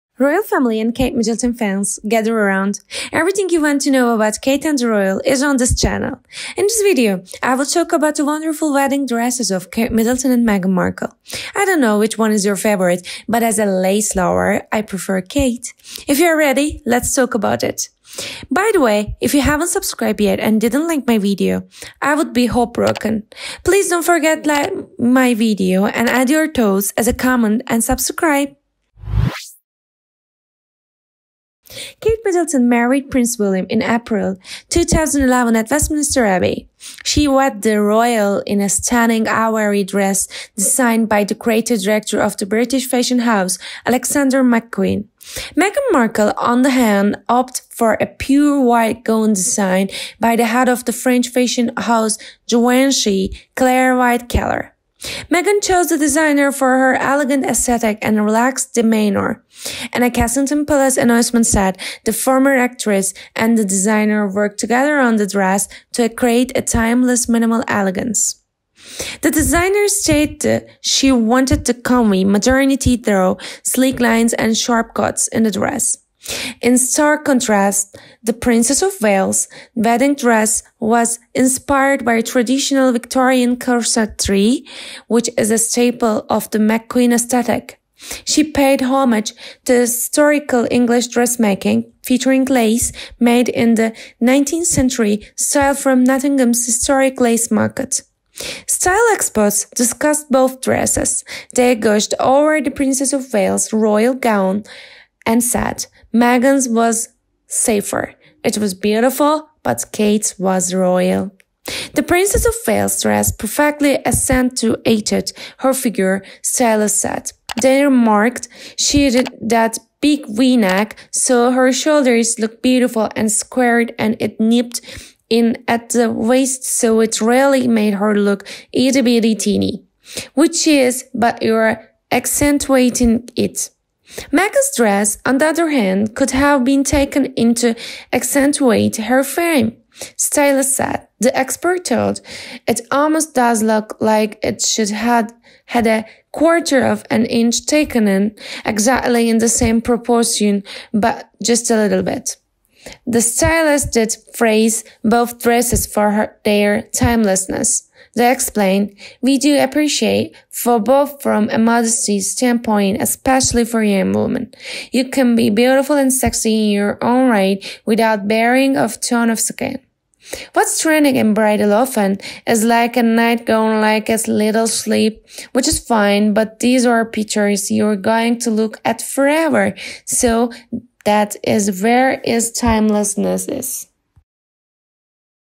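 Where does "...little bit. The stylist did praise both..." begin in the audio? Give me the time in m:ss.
2:31.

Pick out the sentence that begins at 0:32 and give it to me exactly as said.
Kate Middleton married Prince William in April 2011 at Westminster Abbey.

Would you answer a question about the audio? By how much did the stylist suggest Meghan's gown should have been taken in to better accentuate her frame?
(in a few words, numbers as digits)
a quarter of an inch.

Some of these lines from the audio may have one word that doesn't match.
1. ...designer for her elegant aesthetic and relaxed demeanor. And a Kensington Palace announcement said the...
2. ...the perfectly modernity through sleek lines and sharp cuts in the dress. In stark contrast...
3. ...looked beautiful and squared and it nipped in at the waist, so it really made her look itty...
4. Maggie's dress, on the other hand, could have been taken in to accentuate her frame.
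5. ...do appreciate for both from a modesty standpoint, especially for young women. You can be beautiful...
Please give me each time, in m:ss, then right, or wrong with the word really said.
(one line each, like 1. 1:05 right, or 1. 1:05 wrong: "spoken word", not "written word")
1. 0:55 right
2. 1:11 wrong: "comely", not "perfectly"
3. 2:02 right
4. 2:14 right
5. 2:39 right.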